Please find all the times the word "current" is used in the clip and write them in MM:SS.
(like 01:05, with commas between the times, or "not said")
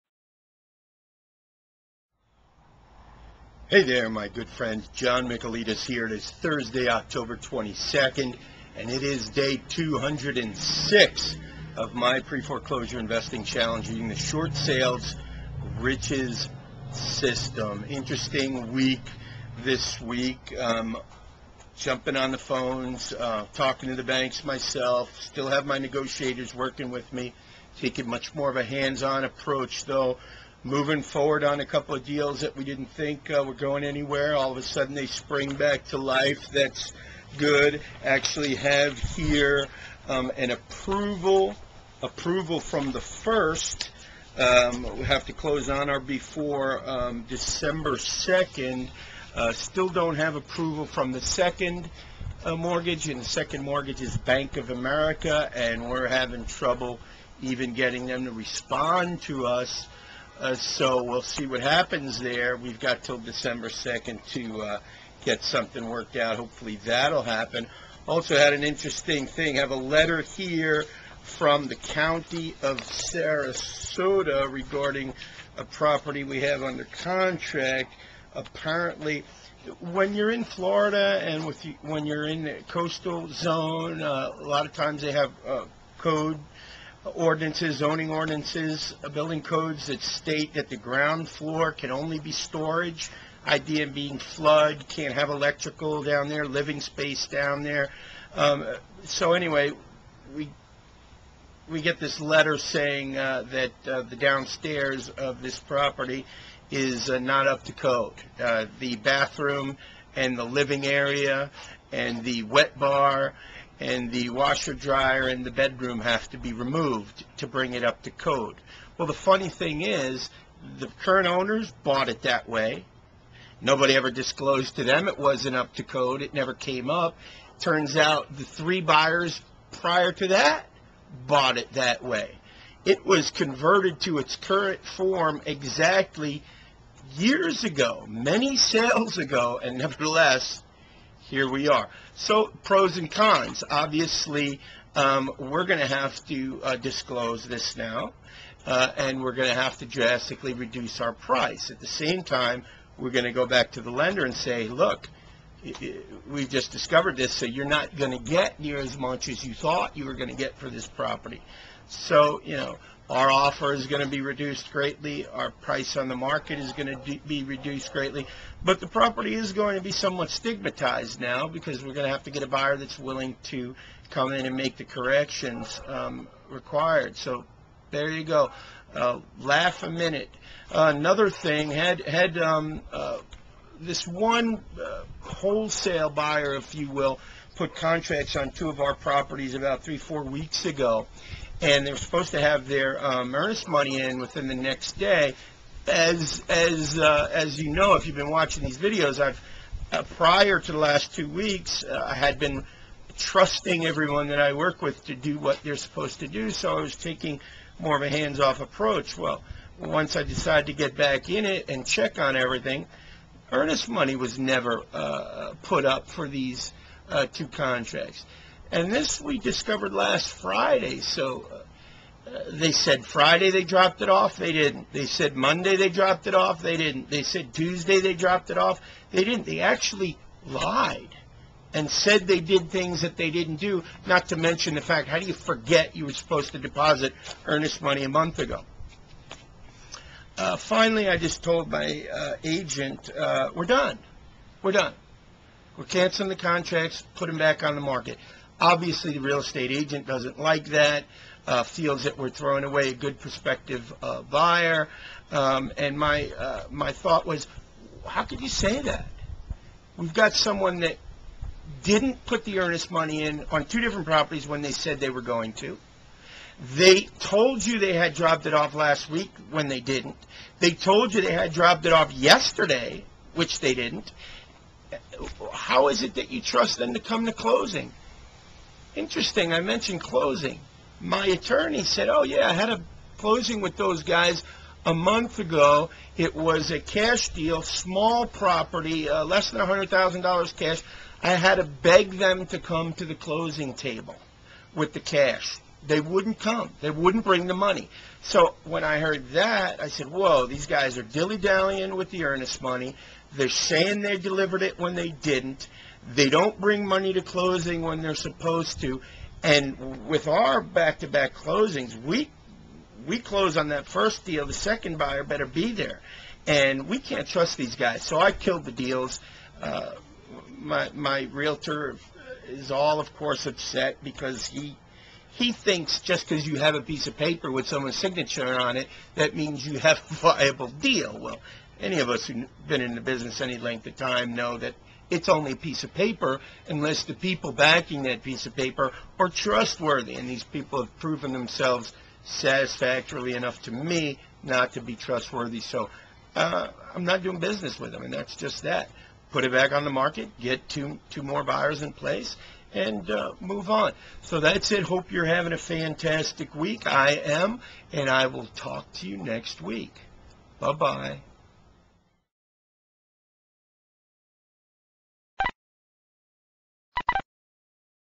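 02:01, 02:14.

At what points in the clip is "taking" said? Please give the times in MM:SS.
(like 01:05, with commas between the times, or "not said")
00:27, 03:26.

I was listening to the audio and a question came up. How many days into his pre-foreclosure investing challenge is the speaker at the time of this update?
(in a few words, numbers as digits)
206.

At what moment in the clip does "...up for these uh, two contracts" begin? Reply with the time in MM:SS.
03:35.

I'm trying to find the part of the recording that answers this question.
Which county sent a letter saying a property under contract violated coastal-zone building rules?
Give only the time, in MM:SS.
01:12.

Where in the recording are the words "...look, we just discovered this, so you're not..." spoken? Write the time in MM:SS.
02:34.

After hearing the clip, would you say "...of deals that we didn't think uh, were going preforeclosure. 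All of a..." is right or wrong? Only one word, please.
wrong.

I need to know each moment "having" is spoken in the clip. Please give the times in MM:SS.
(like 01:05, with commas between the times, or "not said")
00:56, 05:55.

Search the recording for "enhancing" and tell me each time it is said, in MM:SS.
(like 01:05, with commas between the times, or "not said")
not said.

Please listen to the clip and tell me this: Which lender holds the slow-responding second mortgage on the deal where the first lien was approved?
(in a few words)
Bank of America.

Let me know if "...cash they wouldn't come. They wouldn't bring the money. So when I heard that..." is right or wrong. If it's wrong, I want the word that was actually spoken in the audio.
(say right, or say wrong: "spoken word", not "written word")
right.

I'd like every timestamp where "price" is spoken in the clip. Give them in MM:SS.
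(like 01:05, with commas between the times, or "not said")
02:31, 02:45.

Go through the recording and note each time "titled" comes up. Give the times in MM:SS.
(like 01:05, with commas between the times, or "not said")
not said.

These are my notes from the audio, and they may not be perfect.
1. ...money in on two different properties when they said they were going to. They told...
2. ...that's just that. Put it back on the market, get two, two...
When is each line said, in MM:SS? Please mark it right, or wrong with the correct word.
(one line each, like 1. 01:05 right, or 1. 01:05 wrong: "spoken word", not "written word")
1. 04:22 right
2. 05:48 right.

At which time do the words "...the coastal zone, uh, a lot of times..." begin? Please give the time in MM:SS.
01:22.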